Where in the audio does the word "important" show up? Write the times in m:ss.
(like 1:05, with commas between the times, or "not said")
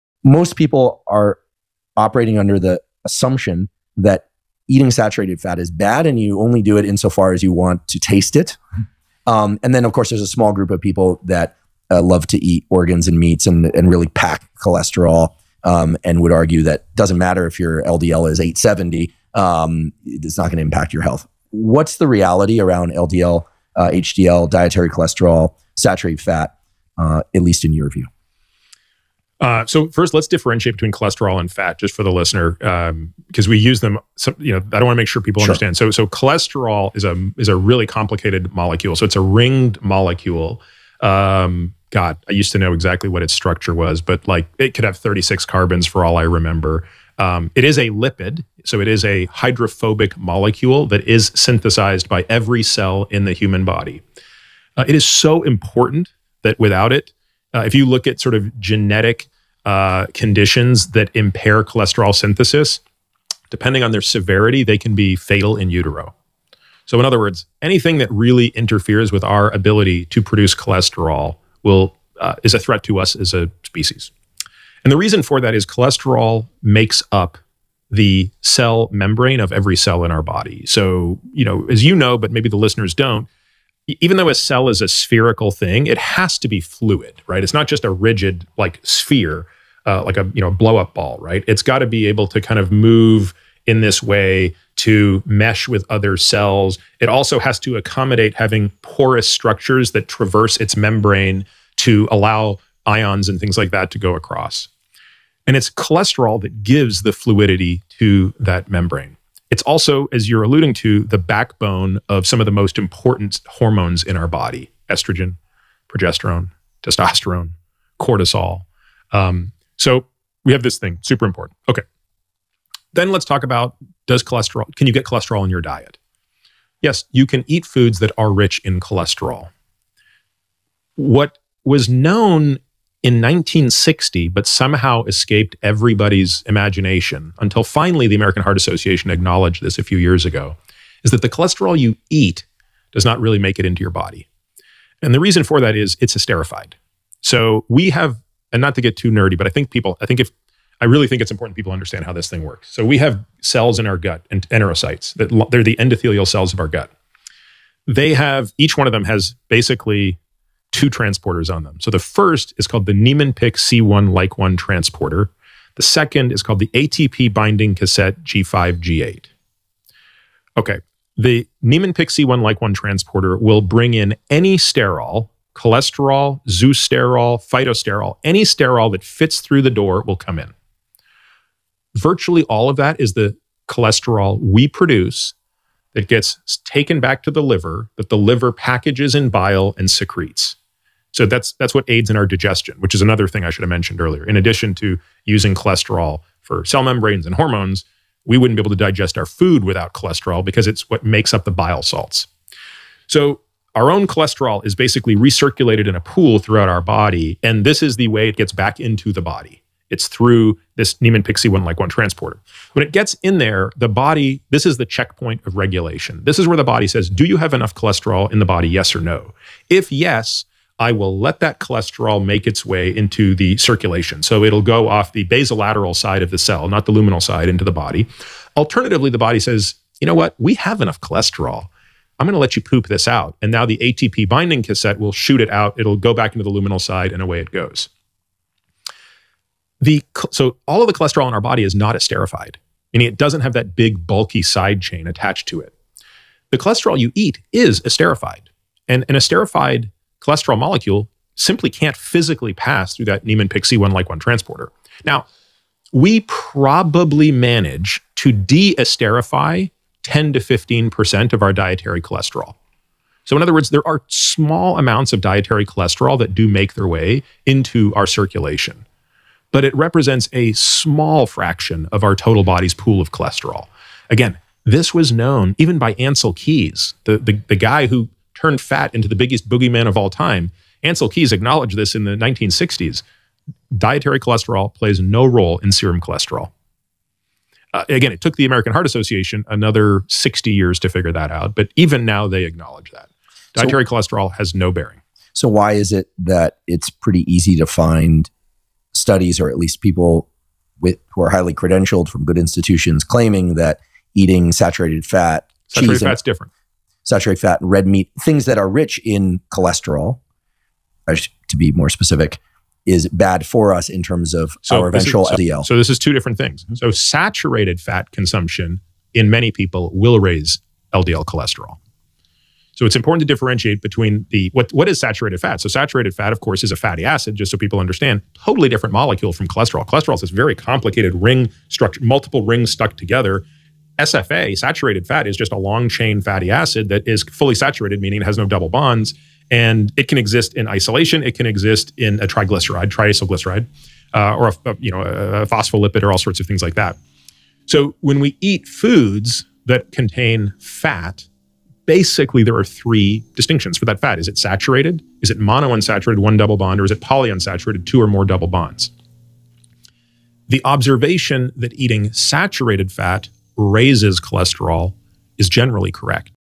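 0:55, 1:52, 2:01, 2:31, 5:22.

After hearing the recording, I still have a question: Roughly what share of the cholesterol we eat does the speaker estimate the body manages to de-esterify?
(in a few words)
10 to 15%.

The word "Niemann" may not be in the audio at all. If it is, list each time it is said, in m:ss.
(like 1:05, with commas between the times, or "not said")
2:42, 2:51, 3:31, 4:13.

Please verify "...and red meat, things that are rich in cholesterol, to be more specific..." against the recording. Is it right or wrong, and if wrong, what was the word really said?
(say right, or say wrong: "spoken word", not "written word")
right.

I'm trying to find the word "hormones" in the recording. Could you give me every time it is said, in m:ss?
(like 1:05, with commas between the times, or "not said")
1:53, 3:17.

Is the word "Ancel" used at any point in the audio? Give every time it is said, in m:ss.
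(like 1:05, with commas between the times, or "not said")
4:35, 4:40.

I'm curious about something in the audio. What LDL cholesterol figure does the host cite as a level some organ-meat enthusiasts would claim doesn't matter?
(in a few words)
870.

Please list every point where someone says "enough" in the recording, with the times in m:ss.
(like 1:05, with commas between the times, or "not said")
3:37, 3:50.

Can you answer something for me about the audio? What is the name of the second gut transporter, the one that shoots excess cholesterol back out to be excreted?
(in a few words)
ATP binding cassette G5 G8.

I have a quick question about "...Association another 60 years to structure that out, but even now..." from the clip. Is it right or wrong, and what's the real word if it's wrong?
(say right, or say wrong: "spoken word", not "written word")
wrong: "figure", not "structure".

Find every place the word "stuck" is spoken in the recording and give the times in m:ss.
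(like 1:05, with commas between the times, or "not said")
5:32.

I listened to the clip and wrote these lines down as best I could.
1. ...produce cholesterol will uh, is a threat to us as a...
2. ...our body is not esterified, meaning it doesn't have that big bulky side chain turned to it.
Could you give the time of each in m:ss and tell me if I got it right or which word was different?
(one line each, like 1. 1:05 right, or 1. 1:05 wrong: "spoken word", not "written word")
1. 1:10 right
2. 4:01 wrong: "attached", not "turned".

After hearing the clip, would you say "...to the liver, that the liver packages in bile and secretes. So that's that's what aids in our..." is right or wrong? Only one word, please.
right.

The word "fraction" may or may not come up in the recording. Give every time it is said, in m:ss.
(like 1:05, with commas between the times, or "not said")
4:31.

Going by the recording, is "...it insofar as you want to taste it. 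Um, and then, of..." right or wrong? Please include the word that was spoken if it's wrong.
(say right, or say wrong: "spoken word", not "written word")
right.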